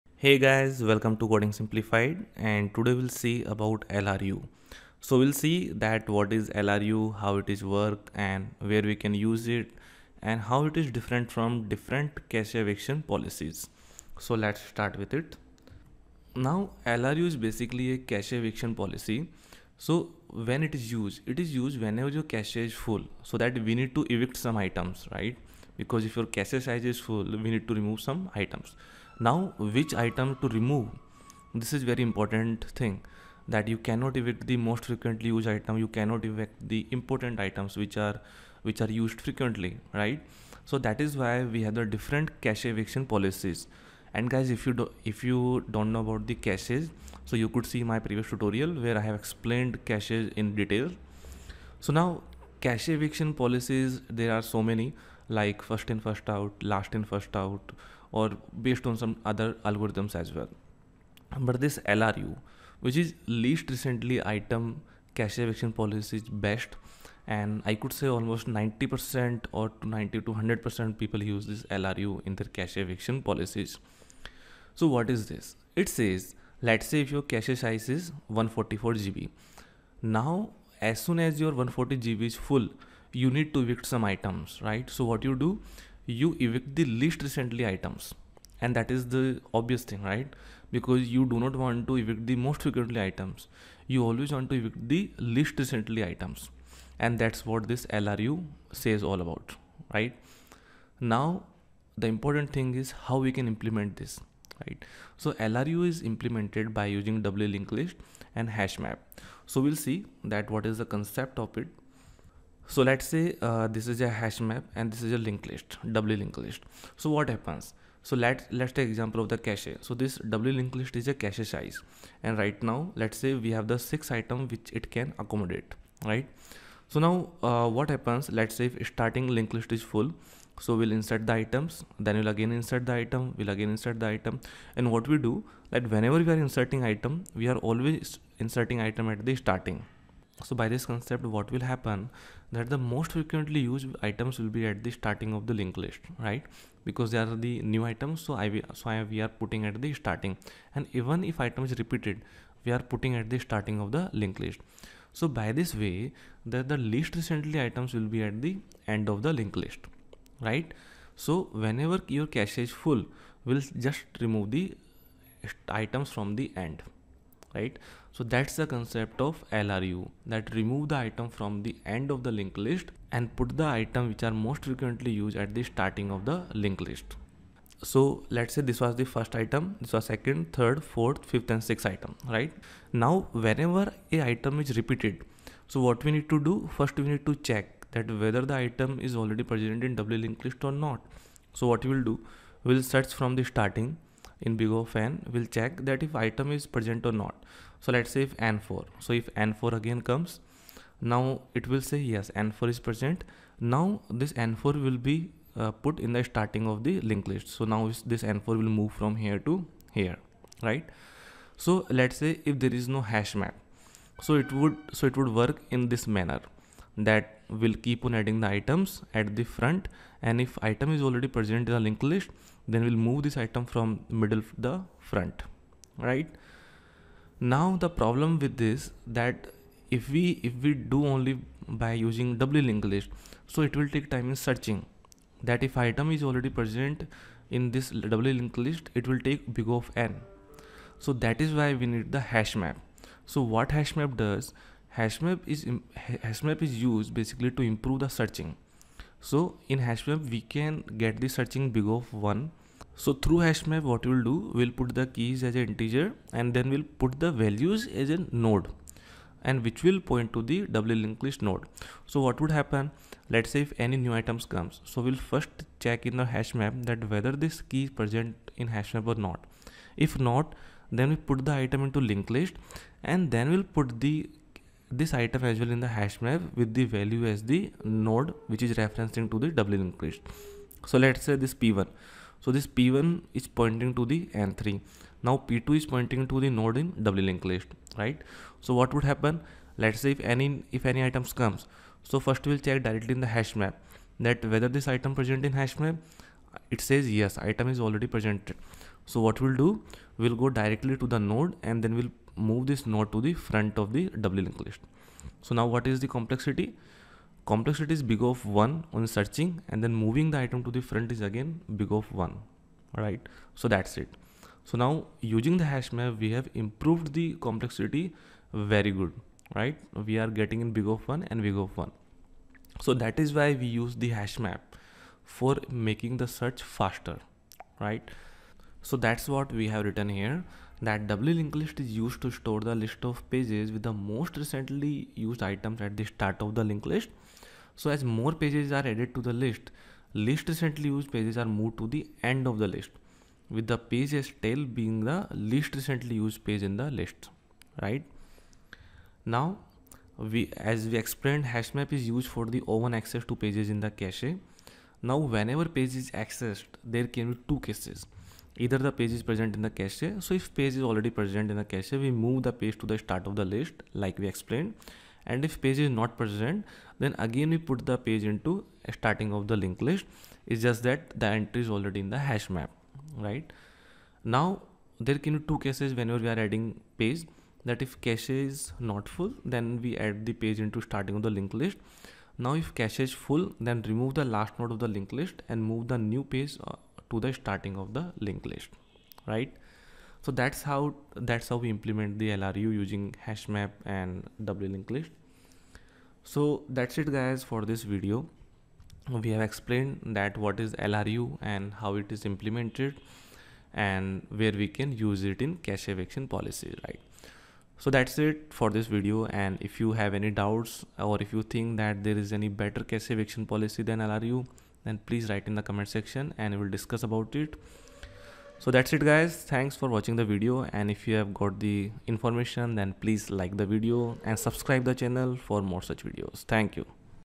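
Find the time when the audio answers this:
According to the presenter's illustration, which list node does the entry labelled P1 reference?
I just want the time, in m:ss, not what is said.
4:44.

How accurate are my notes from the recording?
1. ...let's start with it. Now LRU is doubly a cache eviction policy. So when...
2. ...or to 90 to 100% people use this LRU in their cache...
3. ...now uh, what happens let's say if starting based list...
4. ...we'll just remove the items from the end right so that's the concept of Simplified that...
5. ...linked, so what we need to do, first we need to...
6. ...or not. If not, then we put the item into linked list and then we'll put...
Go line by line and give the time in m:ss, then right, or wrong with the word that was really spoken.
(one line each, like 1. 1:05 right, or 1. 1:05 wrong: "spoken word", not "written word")
1. 0:14 wrong: "basically", not "doubly"
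2. 1:09 right
3. 2:06 wrong: "linked", not "based"
4. 2:43 wrong: "LRU", not "Simplified"
5. 3:04 wrong: "repeated", not "linked"
6. 4:29 right.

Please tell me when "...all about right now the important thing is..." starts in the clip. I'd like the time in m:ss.
1:39.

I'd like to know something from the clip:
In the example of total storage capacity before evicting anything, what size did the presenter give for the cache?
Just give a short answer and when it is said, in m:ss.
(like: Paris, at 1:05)
144 GB, at 1:18.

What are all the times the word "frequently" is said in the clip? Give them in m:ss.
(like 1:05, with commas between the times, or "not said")
0:34, 0:39, 1:32, 2:23, 2:54.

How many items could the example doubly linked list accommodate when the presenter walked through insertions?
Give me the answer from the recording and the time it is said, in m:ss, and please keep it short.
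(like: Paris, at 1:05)
6, at 2:03.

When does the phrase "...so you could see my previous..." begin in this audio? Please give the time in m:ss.
0:47.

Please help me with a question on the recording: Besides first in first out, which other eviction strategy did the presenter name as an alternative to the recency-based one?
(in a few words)
last in, first out.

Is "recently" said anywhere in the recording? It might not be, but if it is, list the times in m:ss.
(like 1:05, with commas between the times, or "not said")
1:03, 1:27, 1:35, 2:37, 5:34, 5:40, 5:45.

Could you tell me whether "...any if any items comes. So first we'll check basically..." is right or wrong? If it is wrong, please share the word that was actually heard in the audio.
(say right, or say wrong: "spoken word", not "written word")
wrong: "directly", not "basically".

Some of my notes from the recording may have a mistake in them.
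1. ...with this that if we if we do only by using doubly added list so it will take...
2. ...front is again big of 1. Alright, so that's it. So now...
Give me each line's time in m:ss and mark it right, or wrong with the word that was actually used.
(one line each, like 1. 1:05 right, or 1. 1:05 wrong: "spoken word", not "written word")
1. 3:48 wrong: "linked", not "added"
2. 5:10 right.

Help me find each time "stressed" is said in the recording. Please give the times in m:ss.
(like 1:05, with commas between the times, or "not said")
not said.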